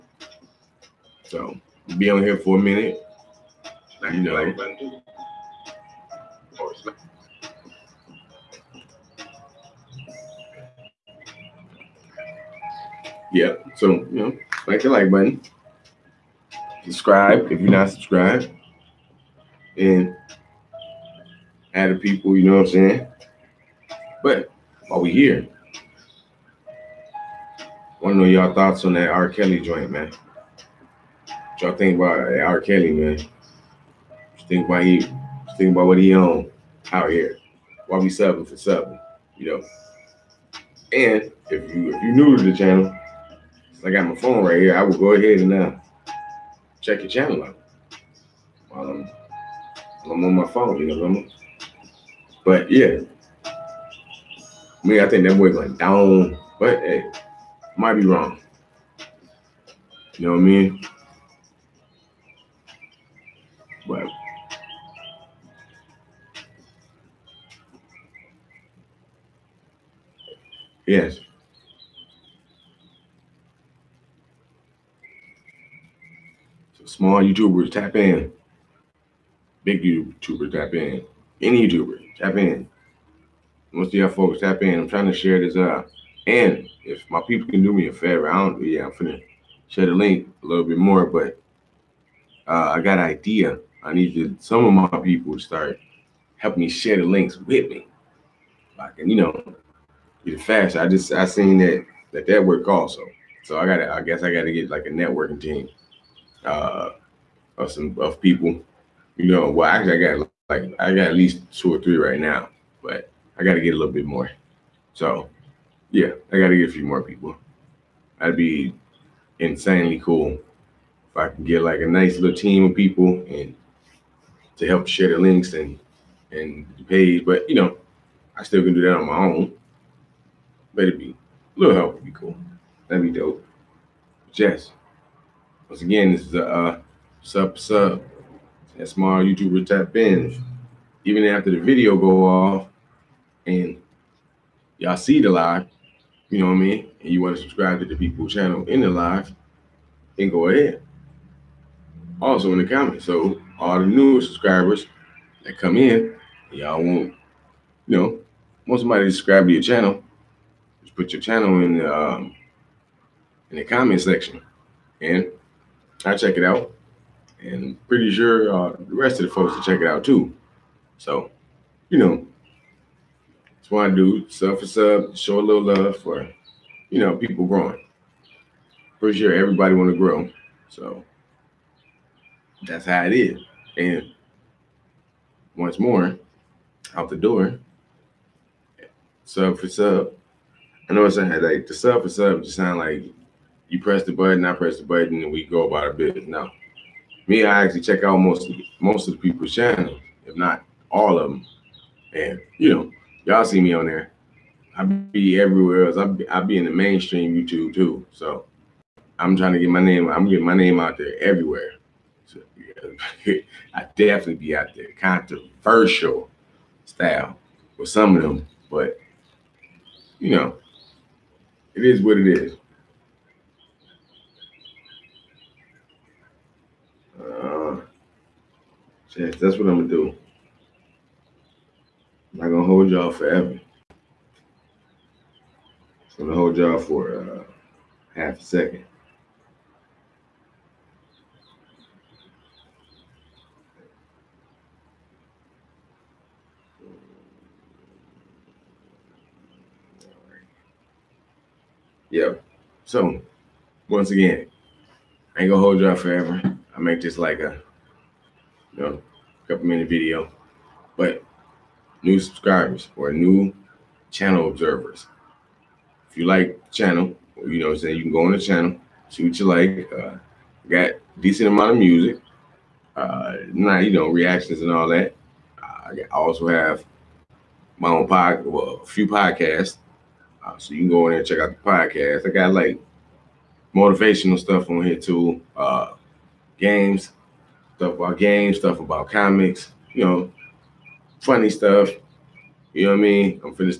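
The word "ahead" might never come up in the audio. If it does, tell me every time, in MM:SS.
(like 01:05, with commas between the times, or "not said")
00:45, 02:30.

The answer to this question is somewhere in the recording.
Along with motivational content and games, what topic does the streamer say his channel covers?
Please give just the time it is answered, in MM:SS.
04:49.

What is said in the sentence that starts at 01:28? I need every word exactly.
Yeah, I'm finna share the link a little bit more.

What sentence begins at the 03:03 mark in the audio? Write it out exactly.
And once more, out the door, sub for sub.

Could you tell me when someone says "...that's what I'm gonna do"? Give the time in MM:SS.
03:49.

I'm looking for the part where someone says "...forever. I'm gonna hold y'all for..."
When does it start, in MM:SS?
03:53.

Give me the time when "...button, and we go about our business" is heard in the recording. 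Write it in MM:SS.
03:14.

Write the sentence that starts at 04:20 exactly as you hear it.
But new subscribers or new channel observers.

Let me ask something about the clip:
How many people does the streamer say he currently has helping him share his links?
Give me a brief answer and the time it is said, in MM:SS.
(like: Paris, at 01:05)
2 or 3, at 01:51.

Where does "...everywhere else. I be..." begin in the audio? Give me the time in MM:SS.
03:25.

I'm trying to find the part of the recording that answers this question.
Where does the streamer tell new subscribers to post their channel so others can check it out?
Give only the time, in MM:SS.
02:43.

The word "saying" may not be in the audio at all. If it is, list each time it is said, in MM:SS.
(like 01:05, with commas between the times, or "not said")
00:22, 04:27.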